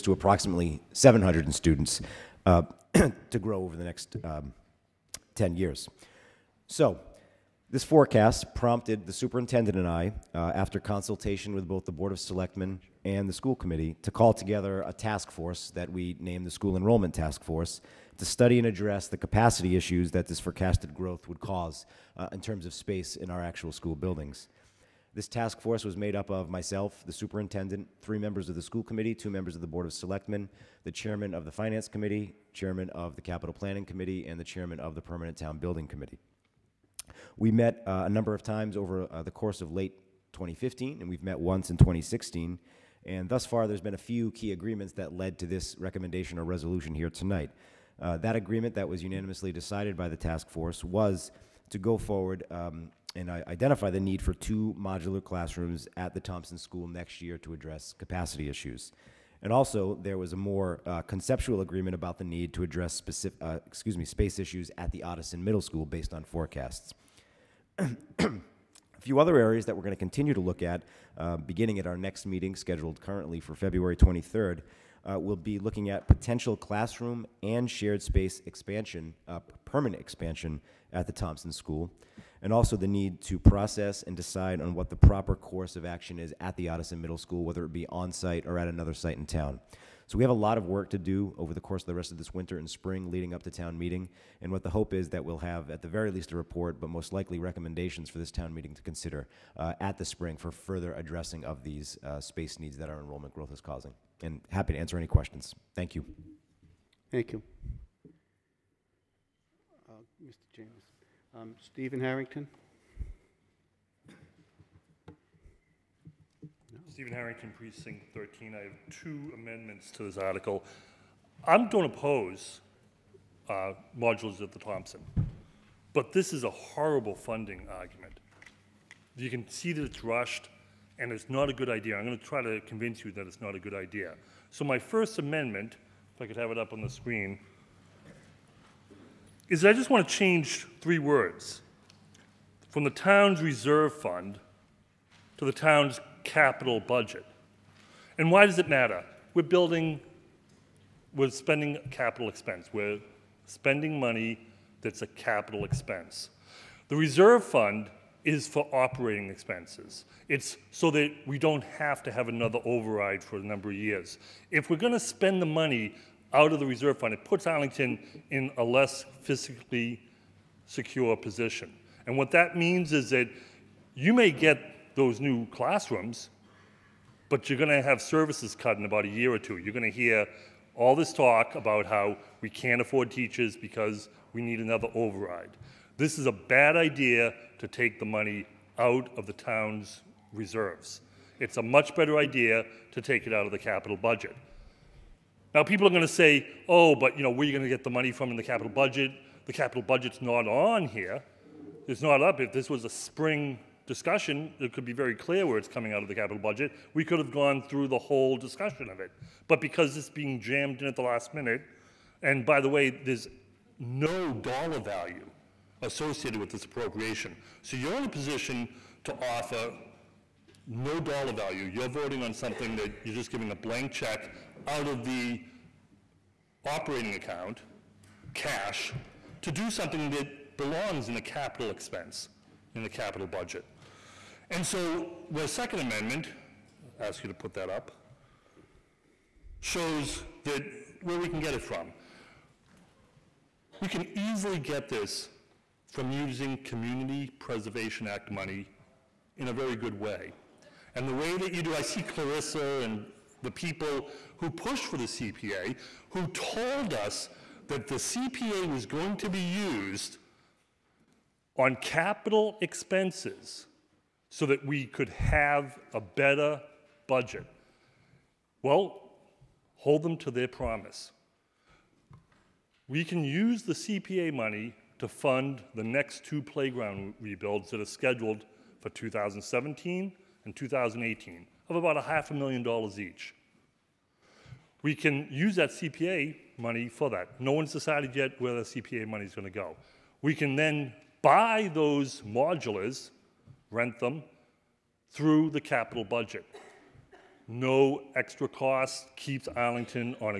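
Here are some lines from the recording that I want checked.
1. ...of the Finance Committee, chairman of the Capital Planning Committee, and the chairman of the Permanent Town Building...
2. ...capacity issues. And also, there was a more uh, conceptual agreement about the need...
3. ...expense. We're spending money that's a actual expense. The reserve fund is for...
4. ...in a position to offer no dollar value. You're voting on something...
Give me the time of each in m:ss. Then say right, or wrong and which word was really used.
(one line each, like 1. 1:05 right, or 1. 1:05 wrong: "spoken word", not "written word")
1. 0:31 right
2. 0:57 right
3. 2:32 wrong: "capital", not "actual"
4. 3:37 right.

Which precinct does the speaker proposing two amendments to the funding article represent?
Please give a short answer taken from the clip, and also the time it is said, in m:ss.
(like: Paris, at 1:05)
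Precinct 13, at 1:57.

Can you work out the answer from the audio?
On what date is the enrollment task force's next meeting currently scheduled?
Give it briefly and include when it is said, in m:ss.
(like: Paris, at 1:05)
February 23rd, at 1:13.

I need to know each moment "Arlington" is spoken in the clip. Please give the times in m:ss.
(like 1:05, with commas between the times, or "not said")
2:47, 4:59.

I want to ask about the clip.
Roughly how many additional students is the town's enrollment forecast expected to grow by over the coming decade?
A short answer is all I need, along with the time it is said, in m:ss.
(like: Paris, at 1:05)
700, at 0:00.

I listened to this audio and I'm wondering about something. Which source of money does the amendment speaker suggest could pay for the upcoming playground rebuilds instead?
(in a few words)
Community Preservation Act.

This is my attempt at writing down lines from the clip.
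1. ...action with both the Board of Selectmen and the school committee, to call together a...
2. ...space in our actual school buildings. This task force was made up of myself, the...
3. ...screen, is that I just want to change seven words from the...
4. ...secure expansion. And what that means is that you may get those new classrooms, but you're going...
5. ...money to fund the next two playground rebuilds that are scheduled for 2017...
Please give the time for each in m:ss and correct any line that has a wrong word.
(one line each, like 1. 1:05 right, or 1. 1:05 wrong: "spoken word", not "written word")
1. 0:10 wrong: "consultation", not "action"
2. 0:22 right
3. 2:16 wrong: "three", not "seven"
4. 2:50 wrong: "position", not "expansion"
5. 4:34 right.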